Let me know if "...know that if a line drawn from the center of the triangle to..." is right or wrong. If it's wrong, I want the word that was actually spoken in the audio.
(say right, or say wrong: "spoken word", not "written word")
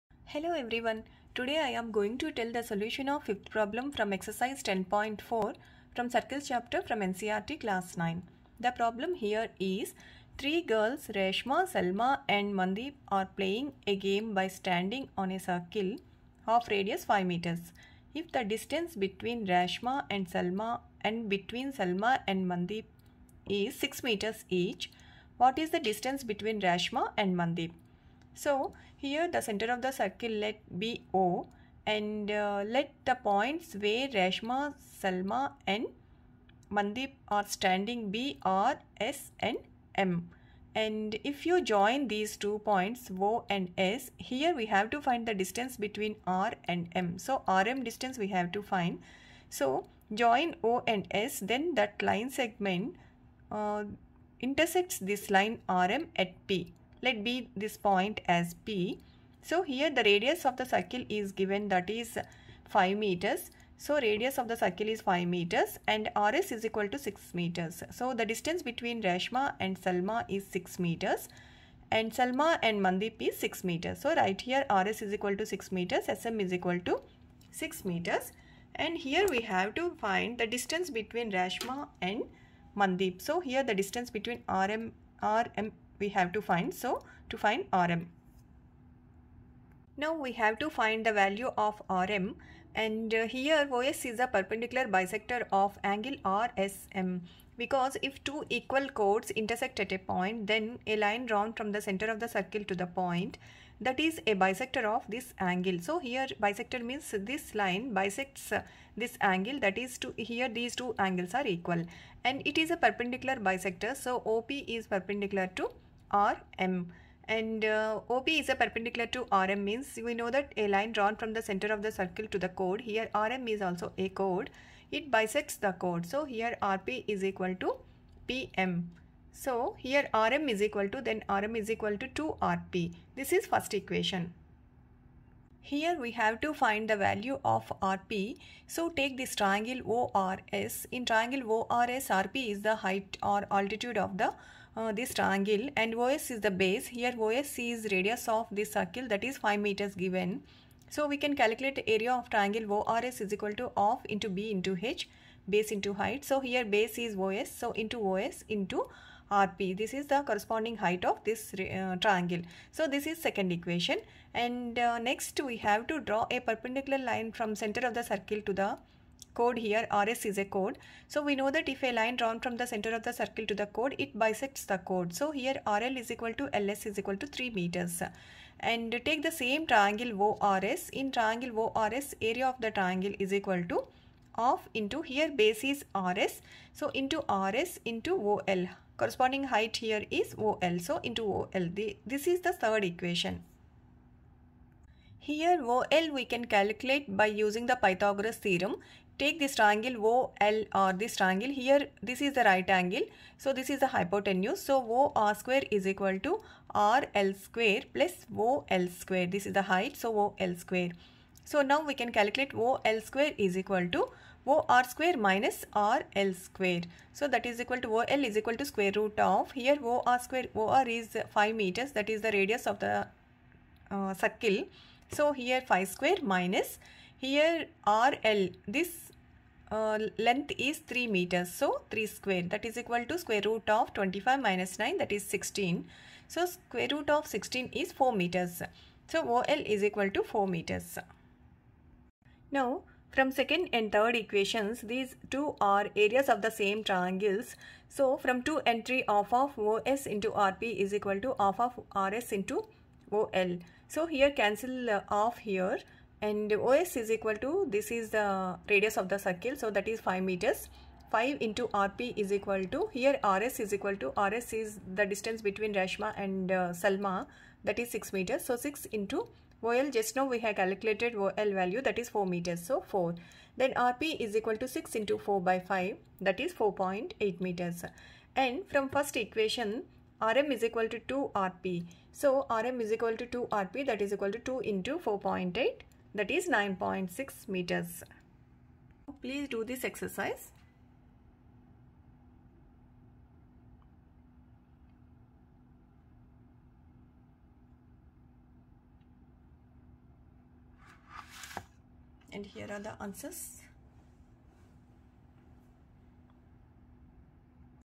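wrong: "circle", not "triangle".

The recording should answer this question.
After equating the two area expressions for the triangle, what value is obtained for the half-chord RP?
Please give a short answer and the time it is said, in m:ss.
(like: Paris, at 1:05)
4.8 meters, at 4:36.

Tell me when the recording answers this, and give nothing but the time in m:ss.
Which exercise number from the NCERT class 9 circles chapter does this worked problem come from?
0:04.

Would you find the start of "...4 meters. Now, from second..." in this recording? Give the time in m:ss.
4:00.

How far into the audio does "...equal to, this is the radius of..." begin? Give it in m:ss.
4:17.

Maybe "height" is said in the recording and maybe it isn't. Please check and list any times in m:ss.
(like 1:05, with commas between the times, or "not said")
2:22, 2:35, 2:40, 3:09, 3:29.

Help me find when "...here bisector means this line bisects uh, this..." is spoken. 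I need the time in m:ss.
1:45.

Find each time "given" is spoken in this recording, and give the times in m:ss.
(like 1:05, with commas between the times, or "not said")
1:01, 2:29.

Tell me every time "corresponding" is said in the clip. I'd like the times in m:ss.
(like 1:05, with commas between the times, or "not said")
2:40, 3:09.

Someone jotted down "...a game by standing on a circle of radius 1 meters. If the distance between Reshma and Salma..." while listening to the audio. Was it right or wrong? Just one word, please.
wrong.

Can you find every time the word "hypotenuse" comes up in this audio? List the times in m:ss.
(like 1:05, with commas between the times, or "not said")
3:23.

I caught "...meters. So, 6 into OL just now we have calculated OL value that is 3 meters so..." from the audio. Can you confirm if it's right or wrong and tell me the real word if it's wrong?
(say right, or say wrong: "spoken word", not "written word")
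wrong: "4", not "3".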